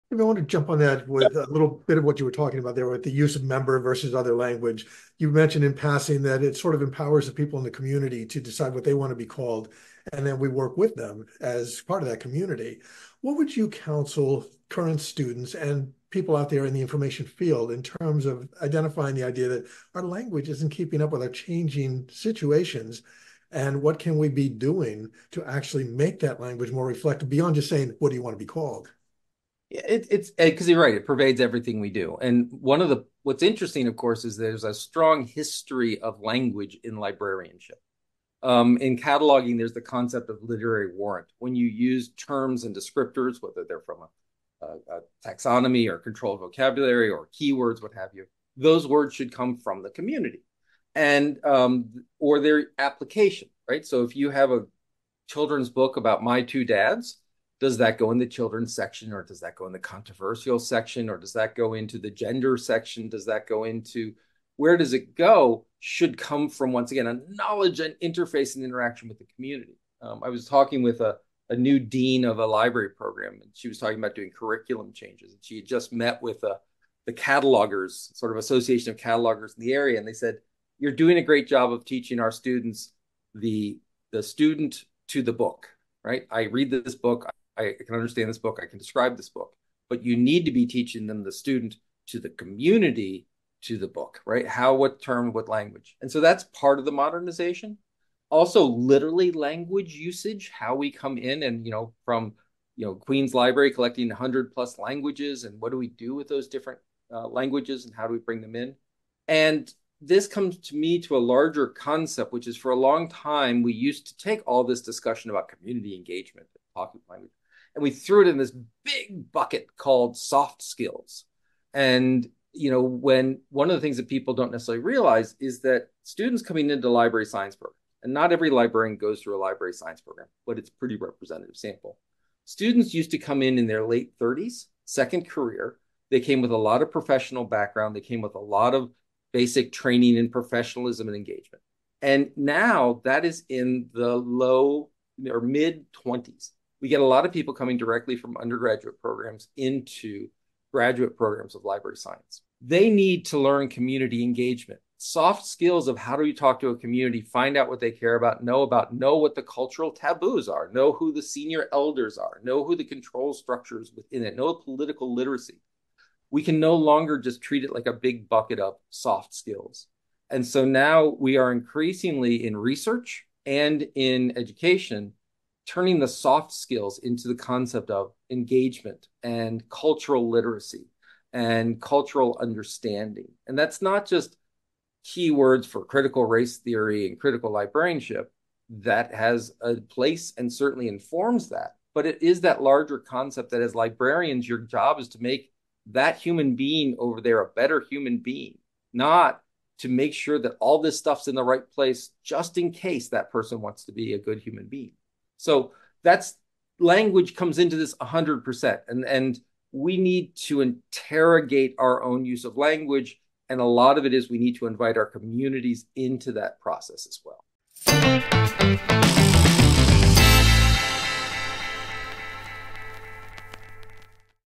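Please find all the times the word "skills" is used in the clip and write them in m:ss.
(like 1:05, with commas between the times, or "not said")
2:00, 2:35, 2:49, 2:56.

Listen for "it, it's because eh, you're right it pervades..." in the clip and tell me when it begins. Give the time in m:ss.
0:29.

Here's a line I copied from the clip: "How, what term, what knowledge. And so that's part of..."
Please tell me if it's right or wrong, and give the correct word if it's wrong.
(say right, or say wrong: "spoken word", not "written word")
wrong: "language", not "knowledge".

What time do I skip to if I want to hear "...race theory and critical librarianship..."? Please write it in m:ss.
3:06.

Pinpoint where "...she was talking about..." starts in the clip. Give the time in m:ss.
1:13.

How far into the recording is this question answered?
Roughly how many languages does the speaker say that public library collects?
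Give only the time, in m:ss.
1:44.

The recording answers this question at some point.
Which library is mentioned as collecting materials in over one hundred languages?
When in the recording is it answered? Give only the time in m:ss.
1:42.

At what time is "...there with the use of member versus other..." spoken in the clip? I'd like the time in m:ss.
0:02.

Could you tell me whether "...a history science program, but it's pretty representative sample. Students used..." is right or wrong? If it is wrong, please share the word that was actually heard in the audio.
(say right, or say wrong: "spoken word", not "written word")
wrong: "library", not "history".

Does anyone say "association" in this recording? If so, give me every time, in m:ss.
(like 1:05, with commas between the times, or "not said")
1:18.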